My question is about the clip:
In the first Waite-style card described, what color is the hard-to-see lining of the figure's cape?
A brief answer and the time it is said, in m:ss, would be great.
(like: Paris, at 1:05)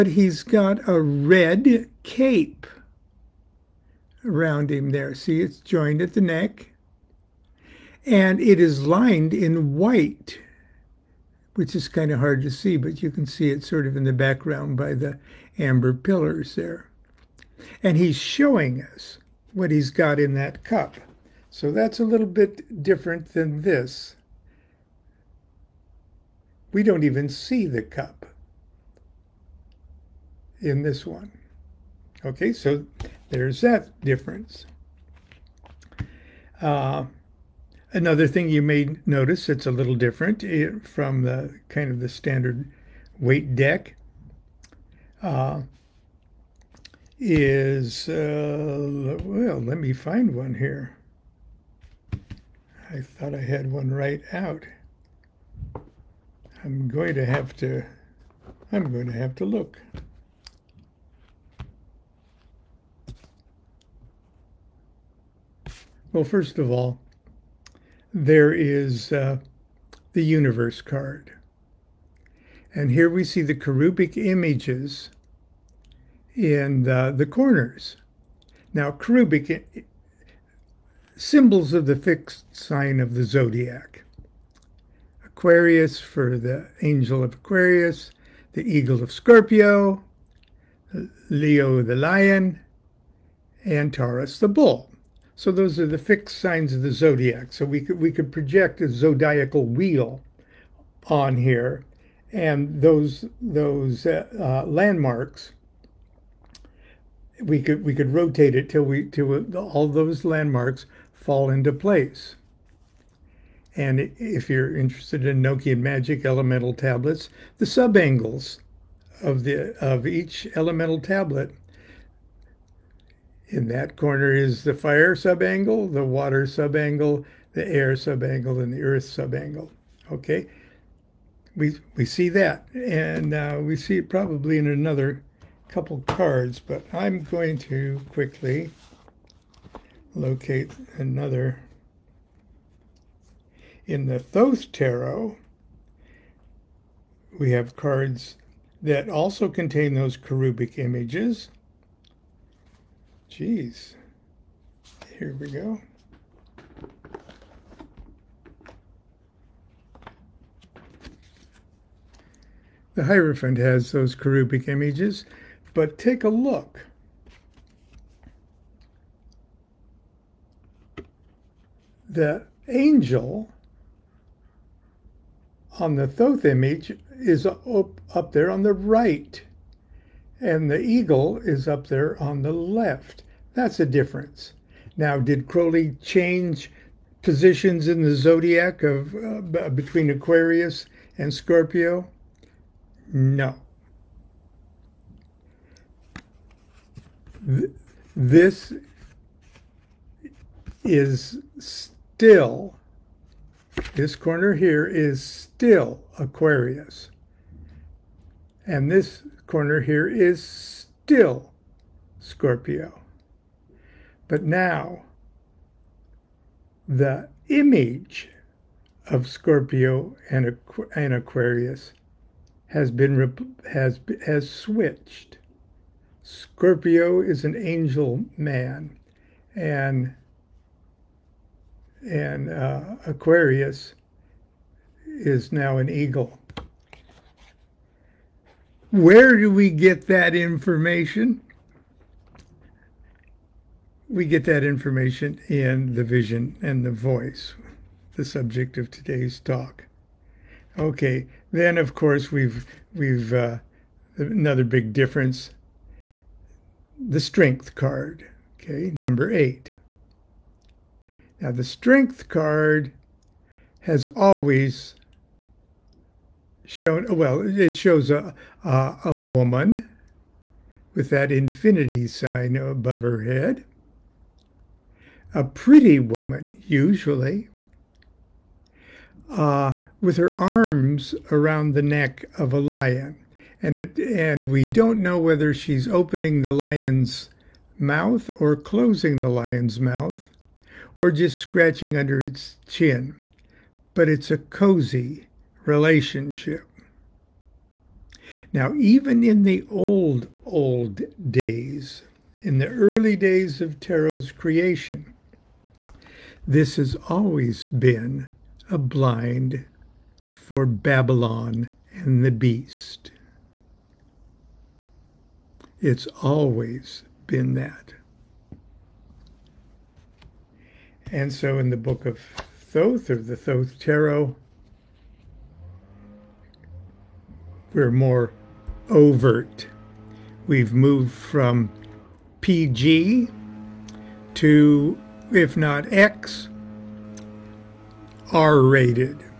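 White, at 0:08.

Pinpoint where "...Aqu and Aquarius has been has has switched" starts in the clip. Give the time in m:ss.
3:40.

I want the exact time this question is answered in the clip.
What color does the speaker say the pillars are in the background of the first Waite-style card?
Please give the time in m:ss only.
0:15.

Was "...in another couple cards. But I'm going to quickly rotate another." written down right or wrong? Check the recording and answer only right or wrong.
wrong.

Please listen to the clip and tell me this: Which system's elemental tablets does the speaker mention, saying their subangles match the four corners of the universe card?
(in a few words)
Enochian Magic.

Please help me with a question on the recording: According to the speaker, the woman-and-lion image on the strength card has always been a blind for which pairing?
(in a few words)
Babylon and the beast.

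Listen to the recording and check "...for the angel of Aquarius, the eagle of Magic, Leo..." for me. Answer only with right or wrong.
wrong.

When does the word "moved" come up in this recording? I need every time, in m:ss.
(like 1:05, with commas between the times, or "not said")
5:30.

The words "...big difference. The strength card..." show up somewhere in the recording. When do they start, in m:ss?
4:14.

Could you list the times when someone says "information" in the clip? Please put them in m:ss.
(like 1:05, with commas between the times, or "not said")
4:00, 4:04.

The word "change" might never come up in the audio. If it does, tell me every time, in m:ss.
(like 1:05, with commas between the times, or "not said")
3:06.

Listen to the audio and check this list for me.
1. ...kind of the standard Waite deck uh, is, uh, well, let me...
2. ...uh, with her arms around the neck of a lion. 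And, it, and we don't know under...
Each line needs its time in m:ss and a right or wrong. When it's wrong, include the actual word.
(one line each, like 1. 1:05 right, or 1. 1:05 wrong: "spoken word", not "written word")
1. 0:41 right
2. 4:39 wrong: "whether", not "under".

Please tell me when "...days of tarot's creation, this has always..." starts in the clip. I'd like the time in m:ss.
5:03.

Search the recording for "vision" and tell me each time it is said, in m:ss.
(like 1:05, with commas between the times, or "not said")
4:06.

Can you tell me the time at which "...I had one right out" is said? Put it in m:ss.
0:53.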